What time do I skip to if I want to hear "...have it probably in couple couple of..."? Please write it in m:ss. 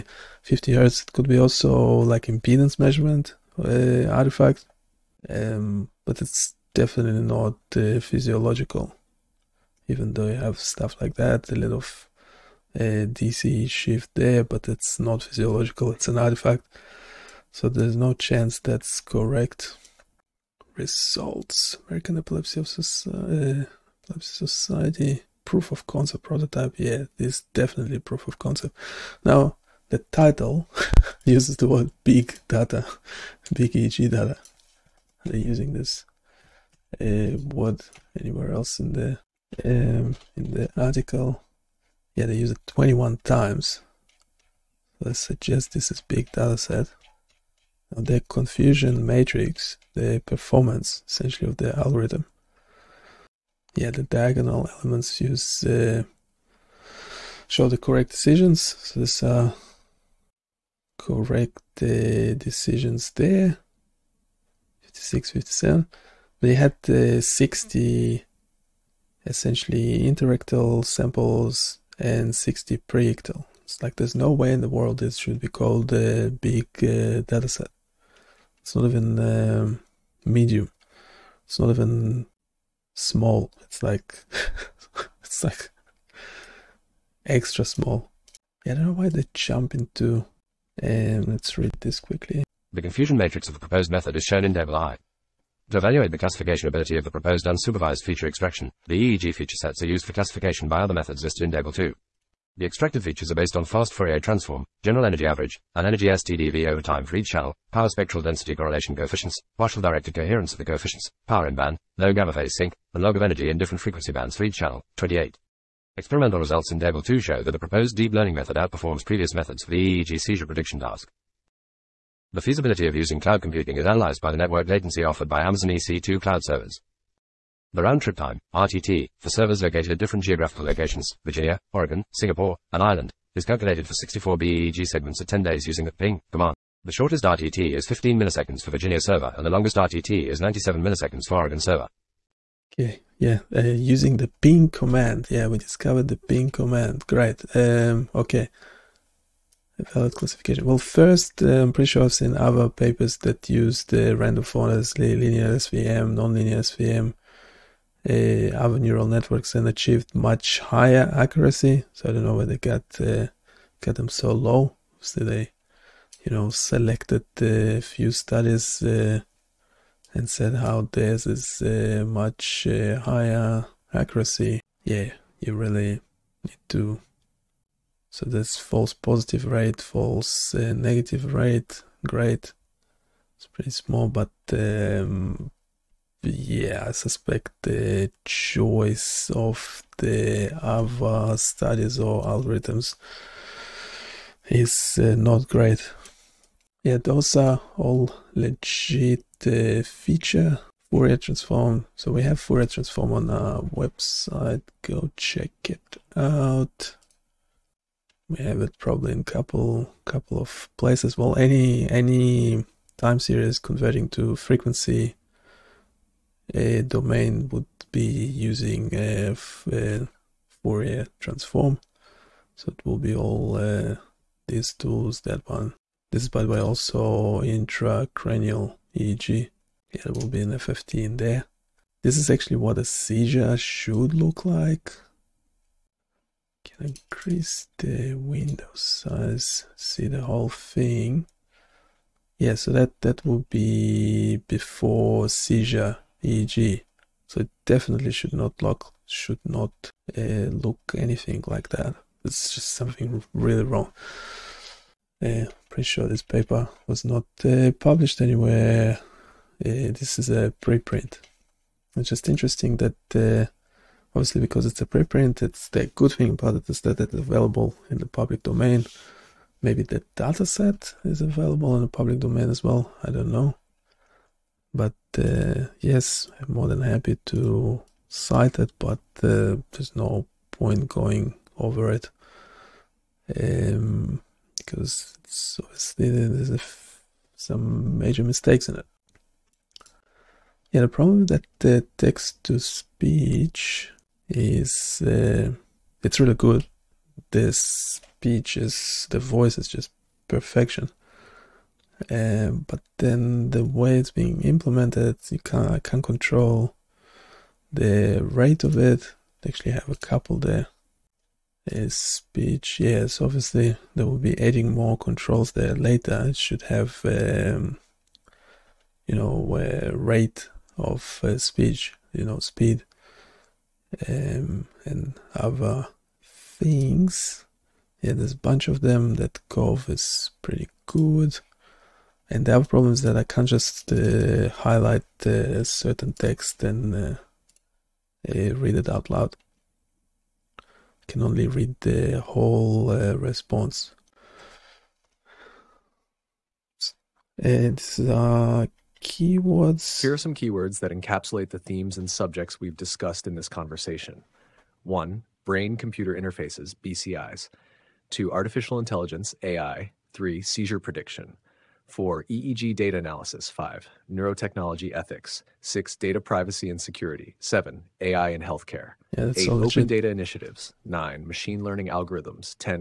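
3:28.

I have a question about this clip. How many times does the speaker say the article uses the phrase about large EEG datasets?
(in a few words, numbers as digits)
21.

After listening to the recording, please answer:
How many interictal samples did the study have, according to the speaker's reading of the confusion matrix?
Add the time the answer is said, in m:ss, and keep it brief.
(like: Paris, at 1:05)
60, at 1:07.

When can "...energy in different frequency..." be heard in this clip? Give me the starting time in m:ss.
1:53.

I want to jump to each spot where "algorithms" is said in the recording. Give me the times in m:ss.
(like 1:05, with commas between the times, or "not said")
0:51, 3:12, 6:11.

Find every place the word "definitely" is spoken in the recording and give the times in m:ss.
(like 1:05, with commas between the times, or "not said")
0:06, 0:27, 4:07.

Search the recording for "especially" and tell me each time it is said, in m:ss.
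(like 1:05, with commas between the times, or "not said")
not said.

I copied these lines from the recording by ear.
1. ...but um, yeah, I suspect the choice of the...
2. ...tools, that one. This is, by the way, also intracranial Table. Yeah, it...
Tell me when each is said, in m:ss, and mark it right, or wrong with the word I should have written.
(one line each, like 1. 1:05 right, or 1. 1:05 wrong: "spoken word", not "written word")
1. 3:04 right
2. 3:44 wrong: "EEG", not "Table".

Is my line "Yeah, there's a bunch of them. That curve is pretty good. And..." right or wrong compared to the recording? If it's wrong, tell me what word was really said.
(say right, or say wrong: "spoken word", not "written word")
right.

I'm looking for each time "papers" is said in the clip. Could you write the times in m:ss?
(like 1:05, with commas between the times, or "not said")
2:32, 4:16.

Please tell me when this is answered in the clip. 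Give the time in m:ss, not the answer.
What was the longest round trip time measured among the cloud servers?
2:20.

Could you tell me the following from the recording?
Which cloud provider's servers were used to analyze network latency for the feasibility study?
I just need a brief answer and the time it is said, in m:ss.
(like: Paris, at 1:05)
Amazon EC2, at 2:05.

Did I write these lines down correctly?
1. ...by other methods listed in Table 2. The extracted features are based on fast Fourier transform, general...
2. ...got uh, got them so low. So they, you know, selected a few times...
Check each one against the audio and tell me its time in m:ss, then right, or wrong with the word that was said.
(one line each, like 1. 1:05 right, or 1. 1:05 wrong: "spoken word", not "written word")
1. 1:40 right
2. 2:42 wrong: "studies", not "times".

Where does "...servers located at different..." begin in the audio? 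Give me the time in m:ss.
2:09.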